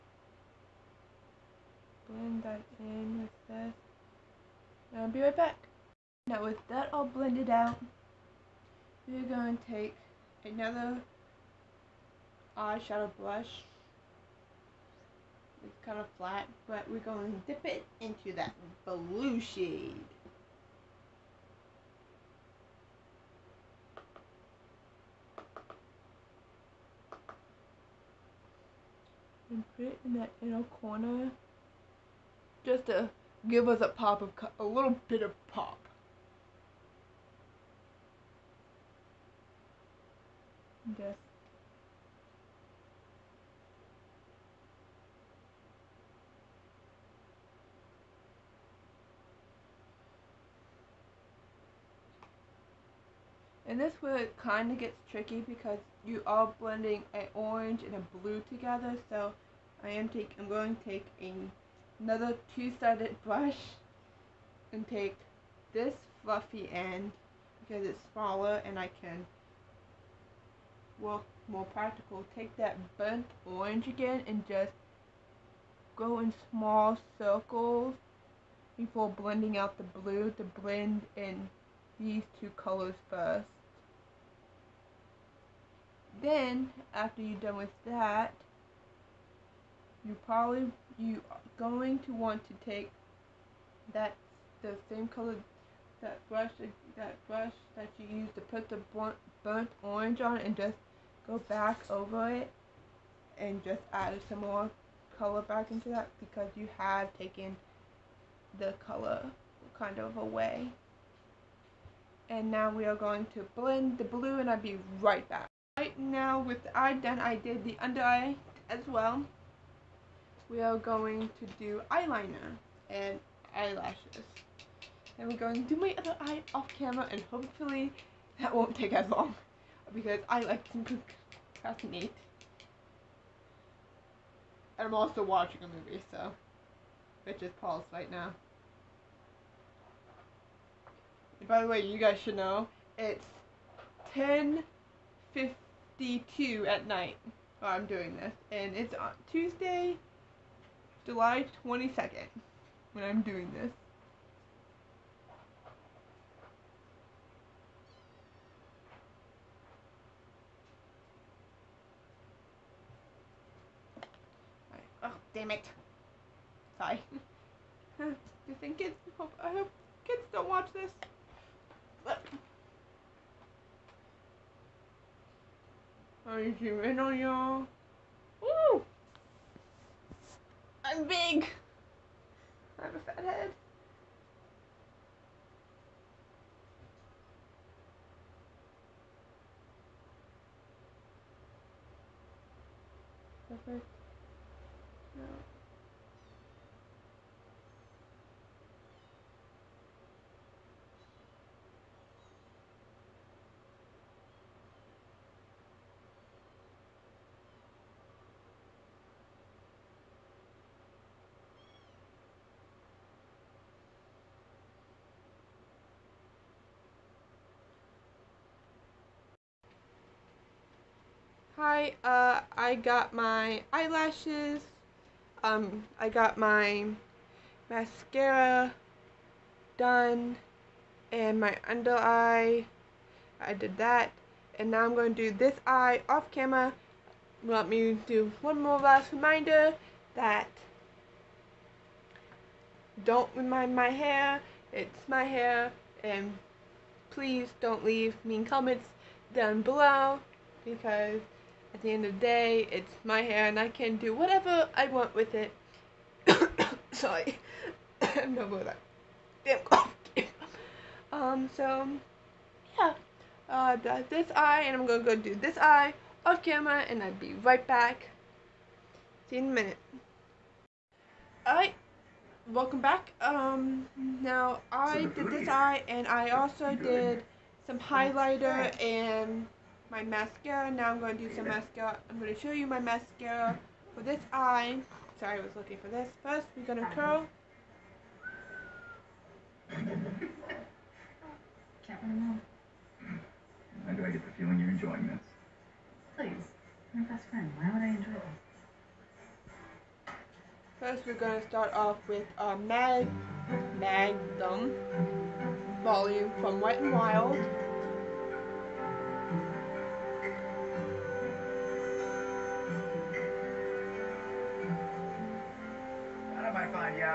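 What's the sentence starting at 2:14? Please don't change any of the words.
And I'm also watching a movie, so which is paused right now.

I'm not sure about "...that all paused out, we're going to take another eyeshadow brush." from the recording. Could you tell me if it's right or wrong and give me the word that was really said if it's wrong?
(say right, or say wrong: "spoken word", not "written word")
wrong: "blended", not "paused".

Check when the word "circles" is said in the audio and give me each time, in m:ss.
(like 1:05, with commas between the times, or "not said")
1:17.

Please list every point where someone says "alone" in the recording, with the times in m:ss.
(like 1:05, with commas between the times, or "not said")
4:52.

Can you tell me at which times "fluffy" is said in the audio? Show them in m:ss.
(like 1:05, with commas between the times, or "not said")
1:06.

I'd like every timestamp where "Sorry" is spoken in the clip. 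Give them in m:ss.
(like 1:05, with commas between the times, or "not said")
2:46, 4:16, 4:45.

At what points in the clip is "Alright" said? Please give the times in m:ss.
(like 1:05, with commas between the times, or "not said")
4:31.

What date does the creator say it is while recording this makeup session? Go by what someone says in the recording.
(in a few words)
Tuesday, July 22nd.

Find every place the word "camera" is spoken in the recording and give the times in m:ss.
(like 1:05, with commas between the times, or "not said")
2:06, 3:56, 4:26.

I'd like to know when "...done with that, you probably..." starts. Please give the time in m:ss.
1:27.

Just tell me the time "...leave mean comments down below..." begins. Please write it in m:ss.
4:07.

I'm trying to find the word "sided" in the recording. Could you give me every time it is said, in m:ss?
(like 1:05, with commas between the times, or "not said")
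1:02.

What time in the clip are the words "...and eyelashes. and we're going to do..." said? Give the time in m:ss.
2:02.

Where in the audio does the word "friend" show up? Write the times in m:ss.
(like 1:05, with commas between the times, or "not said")
4:57.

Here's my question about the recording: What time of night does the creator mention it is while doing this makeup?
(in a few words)
10:52.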